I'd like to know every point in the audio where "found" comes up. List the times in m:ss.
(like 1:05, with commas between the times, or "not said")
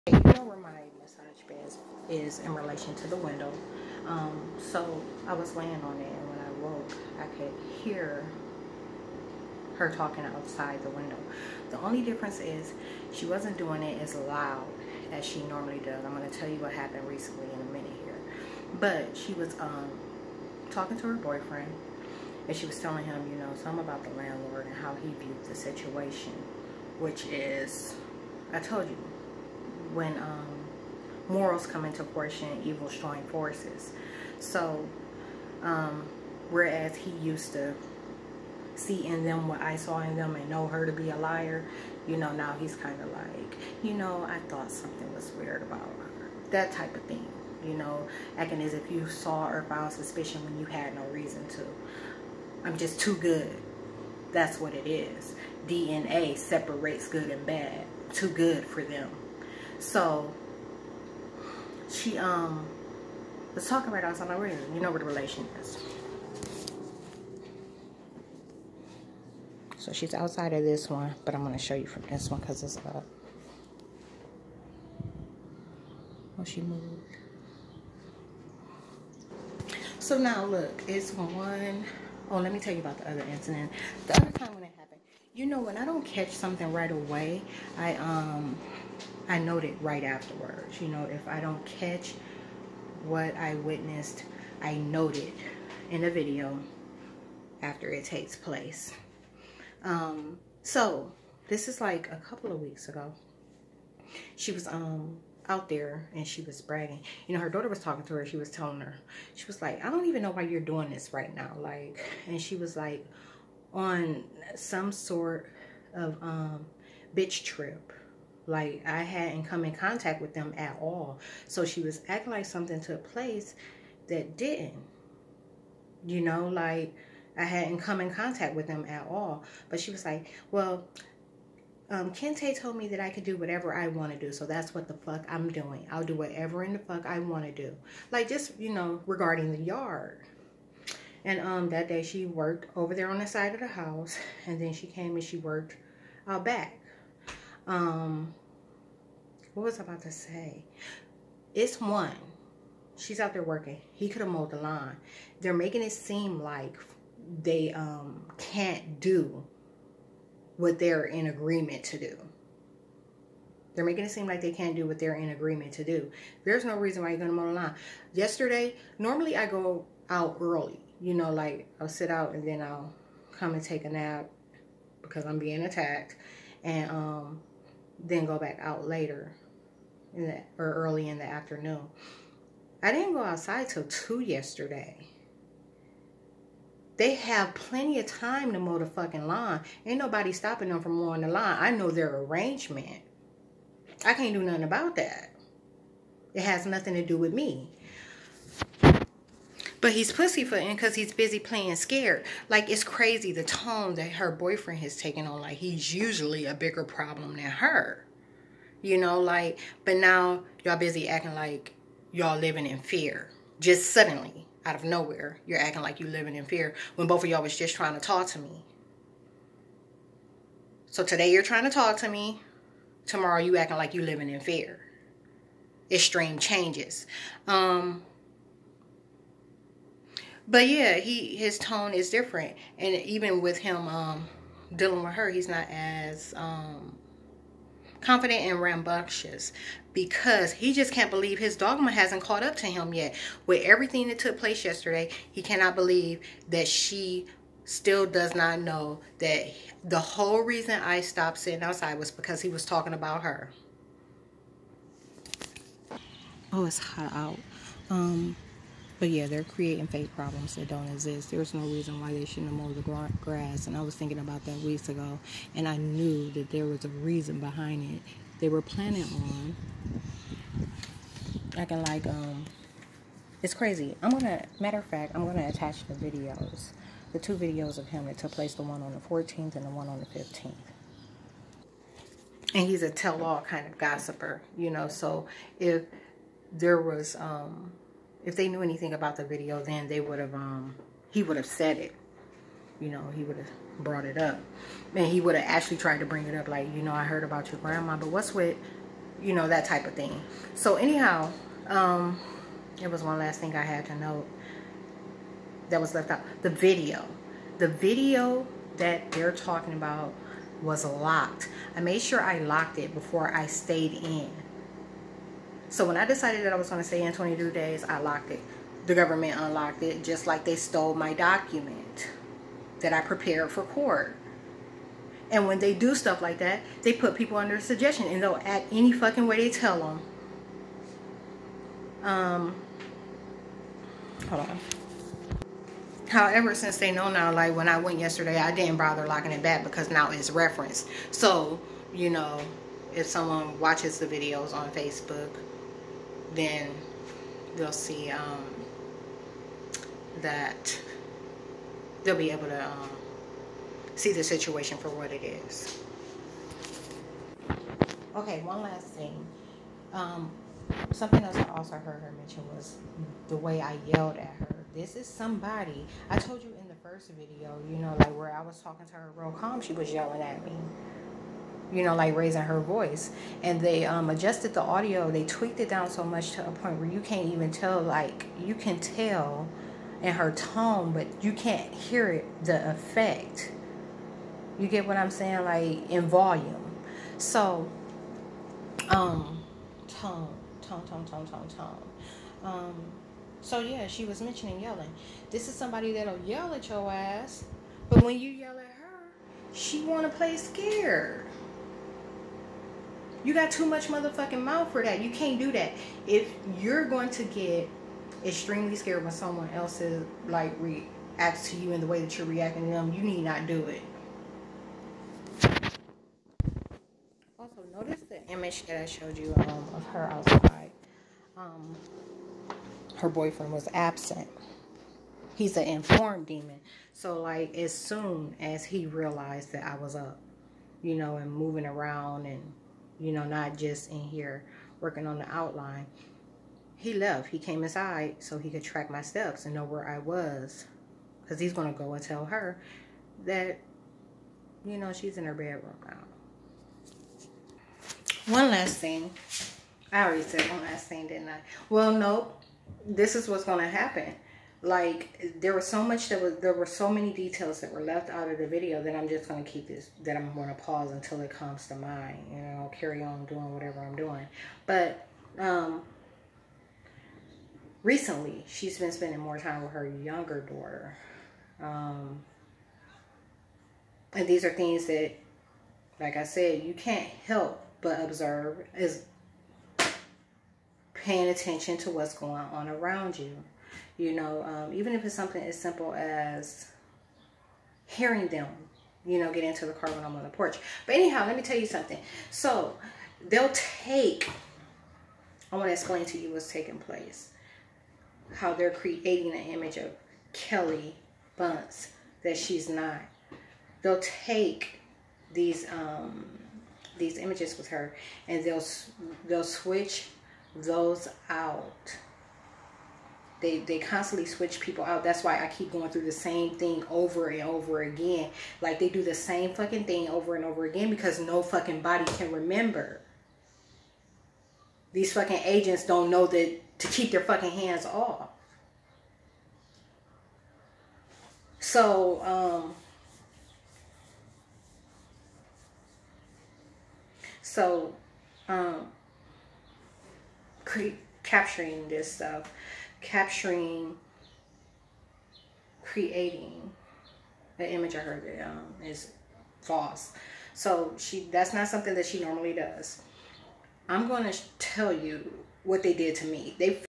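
0:49.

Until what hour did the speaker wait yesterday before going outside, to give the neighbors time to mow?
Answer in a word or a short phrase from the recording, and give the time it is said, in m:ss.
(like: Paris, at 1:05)
2, at 3:03.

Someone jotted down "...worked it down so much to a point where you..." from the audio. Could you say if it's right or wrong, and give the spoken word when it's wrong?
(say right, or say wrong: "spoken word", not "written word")
wrong: "tweaked", not "worked".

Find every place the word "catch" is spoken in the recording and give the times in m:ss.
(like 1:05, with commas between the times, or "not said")
1:26, 1:31.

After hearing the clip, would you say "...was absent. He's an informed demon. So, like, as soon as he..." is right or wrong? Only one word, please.
right.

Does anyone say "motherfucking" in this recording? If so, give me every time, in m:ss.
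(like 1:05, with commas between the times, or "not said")
6:43.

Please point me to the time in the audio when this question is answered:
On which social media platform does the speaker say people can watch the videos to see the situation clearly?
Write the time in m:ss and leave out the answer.
5:44.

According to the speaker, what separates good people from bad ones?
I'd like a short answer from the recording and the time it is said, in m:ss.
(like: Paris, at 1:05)
DNA, at 0:55.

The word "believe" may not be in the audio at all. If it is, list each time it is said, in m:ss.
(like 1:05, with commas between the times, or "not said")
4:01, 4:05.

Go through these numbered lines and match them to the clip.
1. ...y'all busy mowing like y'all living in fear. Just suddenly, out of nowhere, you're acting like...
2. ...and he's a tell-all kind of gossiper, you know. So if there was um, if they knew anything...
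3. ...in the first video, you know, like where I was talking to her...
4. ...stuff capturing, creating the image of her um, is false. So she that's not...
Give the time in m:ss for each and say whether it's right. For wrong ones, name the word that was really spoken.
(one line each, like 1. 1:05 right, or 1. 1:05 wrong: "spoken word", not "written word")
1. 3:30 wrong: "acting", not "mowing"
2. 4:42 right
3. 6:06 right
4. 9:02 right.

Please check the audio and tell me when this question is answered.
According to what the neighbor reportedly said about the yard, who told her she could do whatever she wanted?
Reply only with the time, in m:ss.
2:12.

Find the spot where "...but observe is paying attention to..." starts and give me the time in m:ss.
7:57.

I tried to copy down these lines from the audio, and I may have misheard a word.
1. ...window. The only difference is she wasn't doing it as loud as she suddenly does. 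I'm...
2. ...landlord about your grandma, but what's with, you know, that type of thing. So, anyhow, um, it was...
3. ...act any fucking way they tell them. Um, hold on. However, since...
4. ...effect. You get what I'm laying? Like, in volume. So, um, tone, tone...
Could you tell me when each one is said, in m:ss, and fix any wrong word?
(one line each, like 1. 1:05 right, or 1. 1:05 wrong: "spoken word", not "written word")
1. 0:10 wrong: "normally", not "suddenly"
2. 4:57 wrong: "heard", not "landlord"
3. 5:28 right
4. 6:22 wrong: "saying", not "laying".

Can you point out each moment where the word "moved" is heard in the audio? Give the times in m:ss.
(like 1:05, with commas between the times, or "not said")
1:16.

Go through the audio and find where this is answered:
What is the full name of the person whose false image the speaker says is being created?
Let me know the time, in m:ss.
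8:20.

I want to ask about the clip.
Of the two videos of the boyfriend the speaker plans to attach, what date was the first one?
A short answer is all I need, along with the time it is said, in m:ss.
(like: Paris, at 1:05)
14th, at 4:38.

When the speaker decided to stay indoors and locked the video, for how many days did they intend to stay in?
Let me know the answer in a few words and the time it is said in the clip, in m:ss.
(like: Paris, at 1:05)
22, at 5:17.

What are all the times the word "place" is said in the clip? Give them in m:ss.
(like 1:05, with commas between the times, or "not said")
1:38, 2:03, 4:04, 4:38, 8:16.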